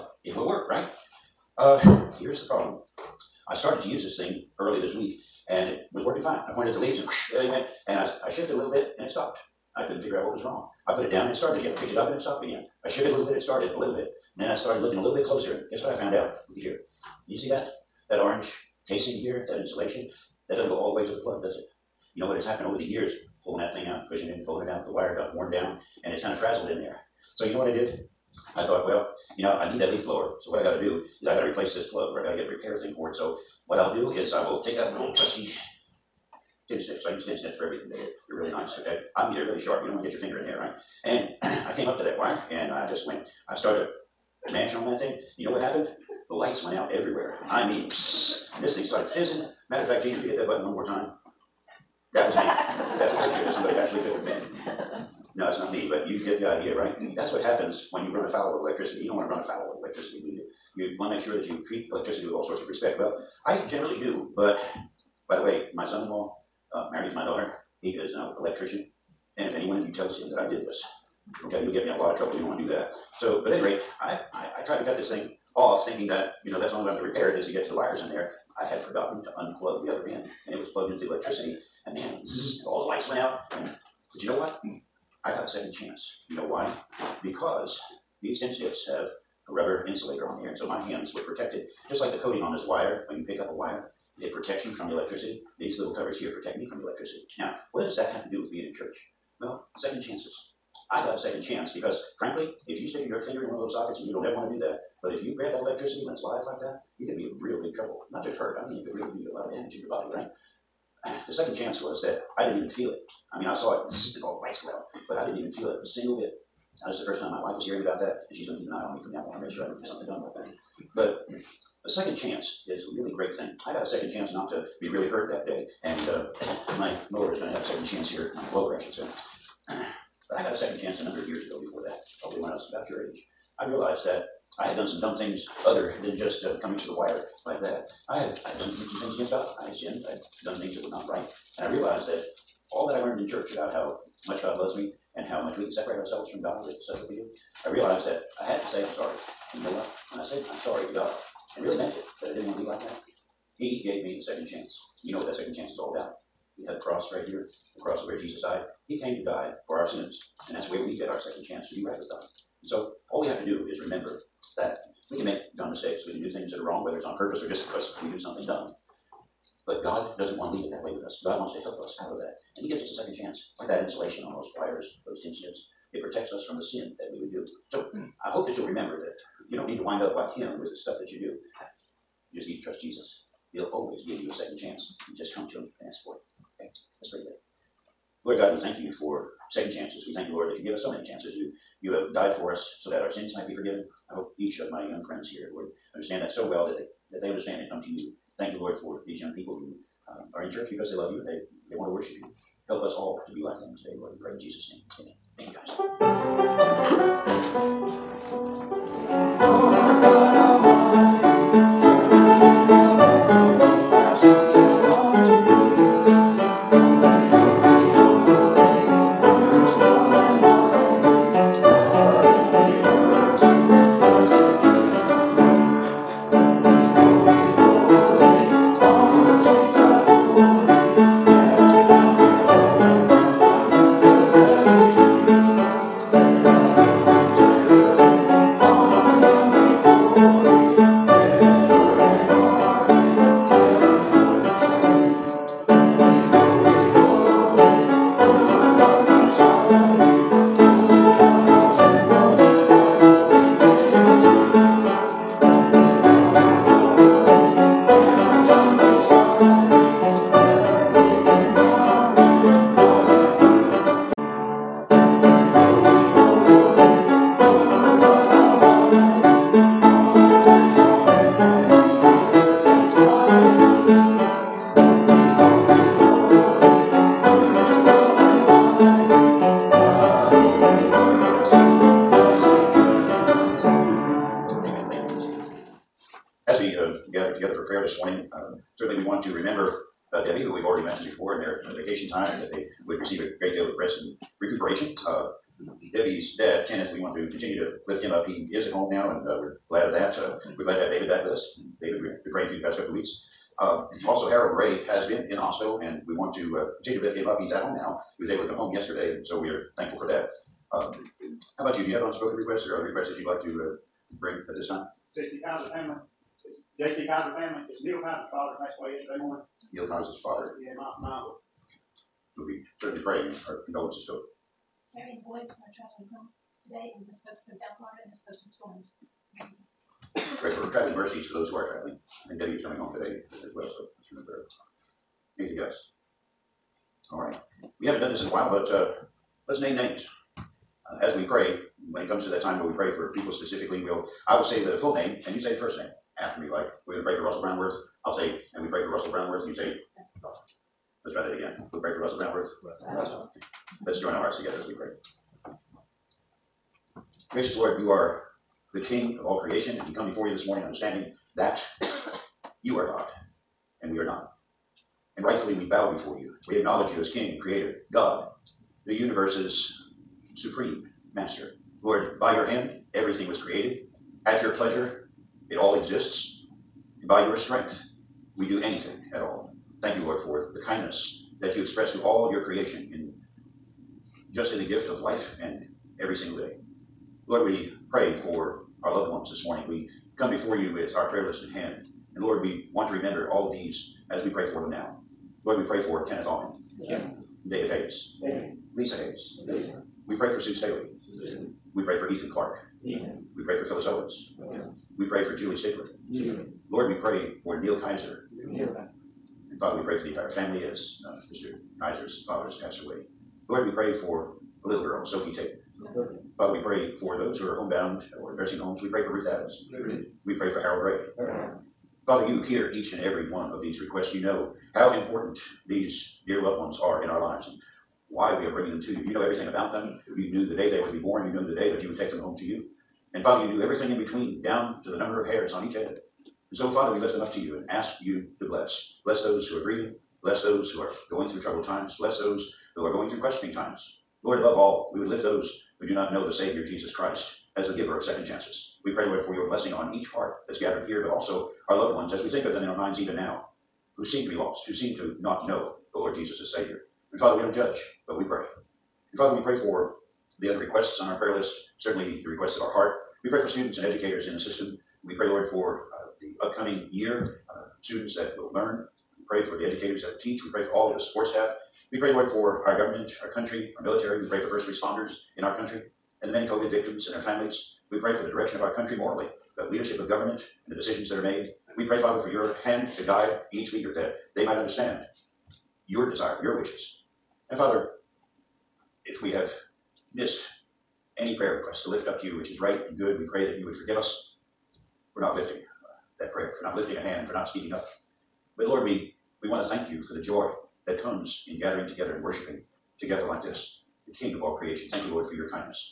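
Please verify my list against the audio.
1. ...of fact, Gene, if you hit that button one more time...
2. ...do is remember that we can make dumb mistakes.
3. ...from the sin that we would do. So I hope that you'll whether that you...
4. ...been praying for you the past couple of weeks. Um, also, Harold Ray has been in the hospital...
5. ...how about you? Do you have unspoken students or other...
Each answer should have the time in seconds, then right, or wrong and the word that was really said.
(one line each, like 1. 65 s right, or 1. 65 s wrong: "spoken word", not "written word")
1. 49 s right
2. 163 s right
3. 176 s wrong: "remember", not "whether"
4. 302 s right
5. 311 s wrong: "requests", not "students".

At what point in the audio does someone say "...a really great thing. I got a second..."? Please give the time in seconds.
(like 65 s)
122 s.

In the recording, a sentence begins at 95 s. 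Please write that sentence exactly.
These little covers here protect me from the electricity.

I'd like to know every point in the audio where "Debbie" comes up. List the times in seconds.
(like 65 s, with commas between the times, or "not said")
290 s, 295 s, 332 s.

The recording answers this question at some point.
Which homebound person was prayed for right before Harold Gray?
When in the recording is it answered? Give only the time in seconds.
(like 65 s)
419 s.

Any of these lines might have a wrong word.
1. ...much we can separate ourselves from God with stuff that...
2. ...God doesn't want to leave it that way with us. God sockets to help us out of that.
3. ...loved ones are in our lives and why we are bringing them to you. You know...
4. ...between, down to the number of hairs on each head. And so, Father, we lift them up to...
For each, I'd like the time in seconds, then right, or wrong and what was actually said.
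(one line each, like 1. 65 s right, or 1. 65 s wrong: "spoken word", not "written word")
1. 145 s right
2. 169 s wrong: "wants", not "sockets"
3. 426 s right
4. 433 s right.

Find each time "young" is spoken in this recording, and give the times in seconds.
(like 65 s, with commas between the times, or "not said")
194 s, 199 s.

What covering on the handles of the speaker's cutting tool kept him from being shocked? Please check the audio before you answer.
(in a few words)
rubber insulator.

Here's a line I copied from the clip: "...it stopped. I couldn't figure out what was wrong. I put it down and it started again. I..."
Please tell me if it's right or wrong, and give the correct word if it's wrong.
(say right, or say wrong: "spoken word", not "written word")
right.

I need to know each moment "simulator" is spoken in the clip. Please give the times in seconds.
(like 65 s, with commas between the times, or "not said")
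not said.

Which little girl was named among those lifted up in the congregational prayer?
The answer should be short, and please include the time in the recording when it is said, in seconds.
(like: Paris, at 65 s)
Sophie Tate, at 415 s.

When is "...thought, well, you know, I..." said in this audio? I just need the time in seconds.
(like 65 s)
28 s.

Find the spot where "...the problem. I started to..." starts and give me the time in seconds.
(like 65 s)
2 s.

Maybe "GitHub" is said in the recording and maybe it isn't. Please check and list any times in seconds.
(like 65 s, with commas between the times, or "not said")
not said.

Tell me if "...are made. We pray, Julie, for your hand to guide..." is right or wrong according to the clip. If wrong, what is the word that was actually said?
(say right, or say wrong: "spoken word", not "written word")
wrong: "Father", not "Julie".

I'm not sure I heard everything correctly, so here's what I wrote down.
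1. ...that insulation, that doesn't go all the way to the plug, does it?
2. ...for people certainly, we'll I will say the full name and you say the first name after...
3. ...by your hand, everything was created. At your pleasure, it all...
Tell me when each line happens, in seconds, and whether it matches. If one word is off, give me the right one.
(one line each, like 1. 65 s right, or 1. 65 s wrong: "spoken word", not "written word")
1. 19 s right
2. 342 s wrong: "specifically", not "certainly"
3. 372 s right.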